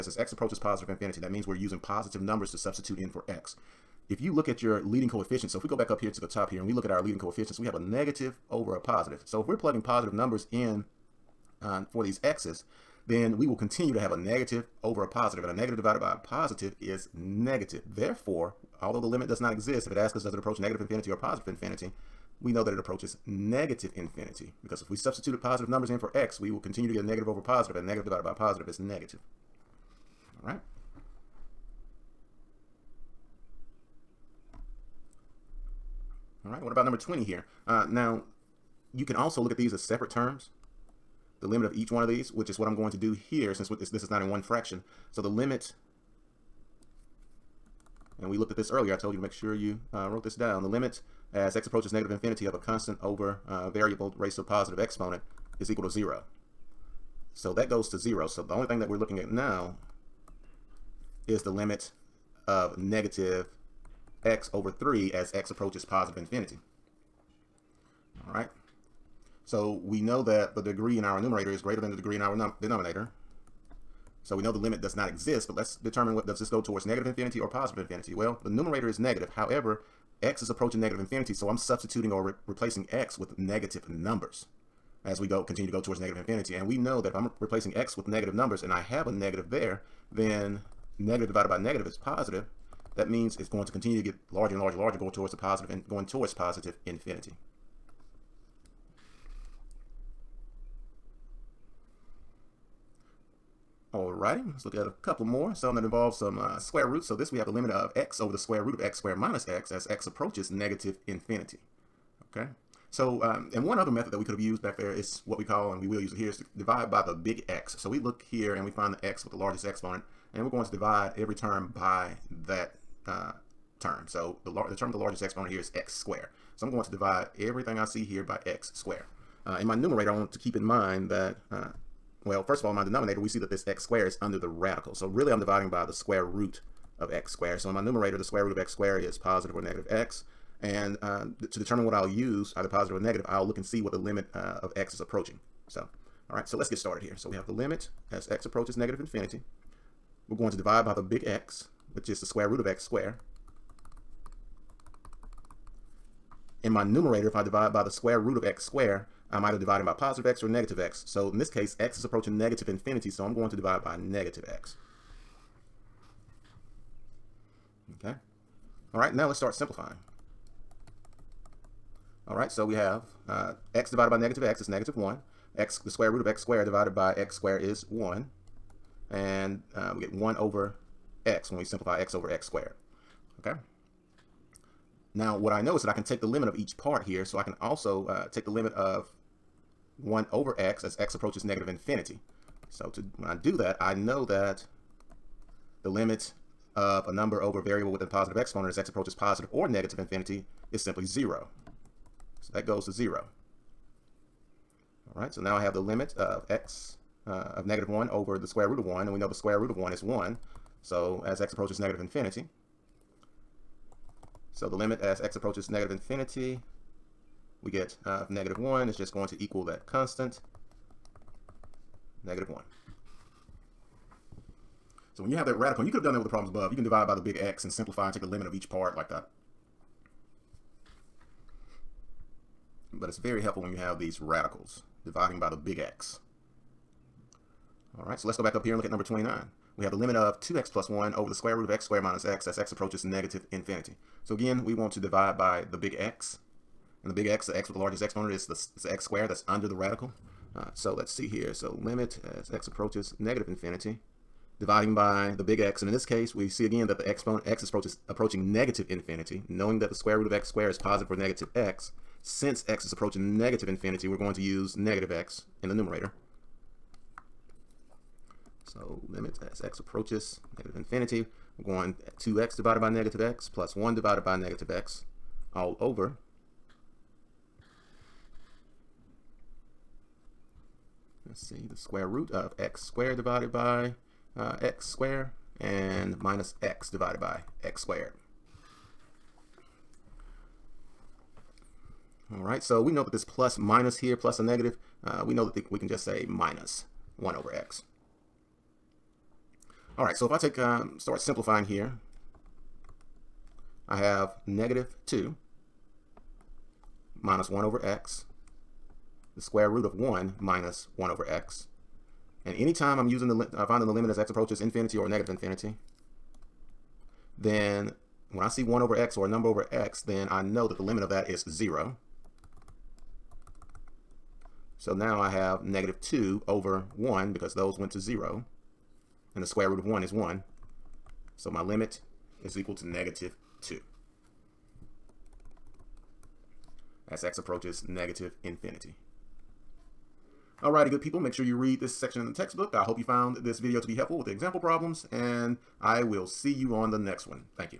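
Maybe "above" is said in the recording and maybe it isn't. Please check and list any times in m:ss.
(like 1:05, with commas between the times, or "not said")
3:46.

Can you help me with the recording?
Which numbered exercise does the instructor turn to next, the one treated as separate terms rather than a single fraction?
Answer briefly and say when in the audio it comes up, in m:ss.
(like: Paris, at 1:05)
20, at 0:36.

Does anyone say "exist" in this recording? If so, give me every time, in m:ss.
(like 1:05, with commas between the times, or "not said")
0:19, 1:15.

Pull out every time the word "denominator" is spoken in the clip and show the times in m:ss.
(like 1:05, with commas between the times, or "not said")
1:12, 2:12.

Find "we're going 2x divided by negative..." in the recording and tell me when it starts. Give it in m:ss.
4:31.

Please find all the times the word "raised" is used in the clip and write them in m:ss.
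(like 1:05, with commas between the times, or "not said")
0:54.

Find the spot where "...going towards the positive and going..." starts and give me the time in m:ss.
1:34.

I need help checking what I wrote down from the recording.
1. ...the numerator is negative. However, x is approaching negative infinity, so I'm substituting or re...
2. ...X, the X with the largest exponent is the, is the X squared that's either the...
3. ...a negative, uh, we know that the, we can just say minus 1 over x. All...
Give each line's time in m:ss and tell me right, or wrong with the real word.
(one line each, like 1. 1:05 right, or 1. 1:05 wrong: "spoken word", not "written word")
1. 1:18 right
2. 4:07 wrong: "under", not "either"
3. 4:54 right.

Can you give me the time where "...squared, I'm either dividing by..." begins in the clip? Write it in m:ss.
2:38.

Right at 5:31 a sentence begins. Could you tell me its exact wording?
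So my limit is equal to negative 2.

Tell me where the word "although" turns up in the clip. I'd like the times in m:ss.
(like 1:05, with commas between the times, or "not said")
0:18.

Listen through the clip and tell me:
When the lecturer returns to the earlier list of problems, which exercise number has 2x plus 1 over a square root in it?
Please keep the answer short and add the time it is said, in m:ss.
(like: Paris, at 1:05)
29, at 3:58.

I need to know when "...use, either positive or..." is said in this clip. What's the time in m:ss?
2:22.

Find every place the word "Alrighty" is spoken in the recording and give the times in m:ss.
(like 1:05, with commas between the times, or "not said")
1:43, 5:40.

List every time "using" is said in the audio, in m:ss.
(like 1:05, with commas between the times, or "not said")
0:01, 5:13.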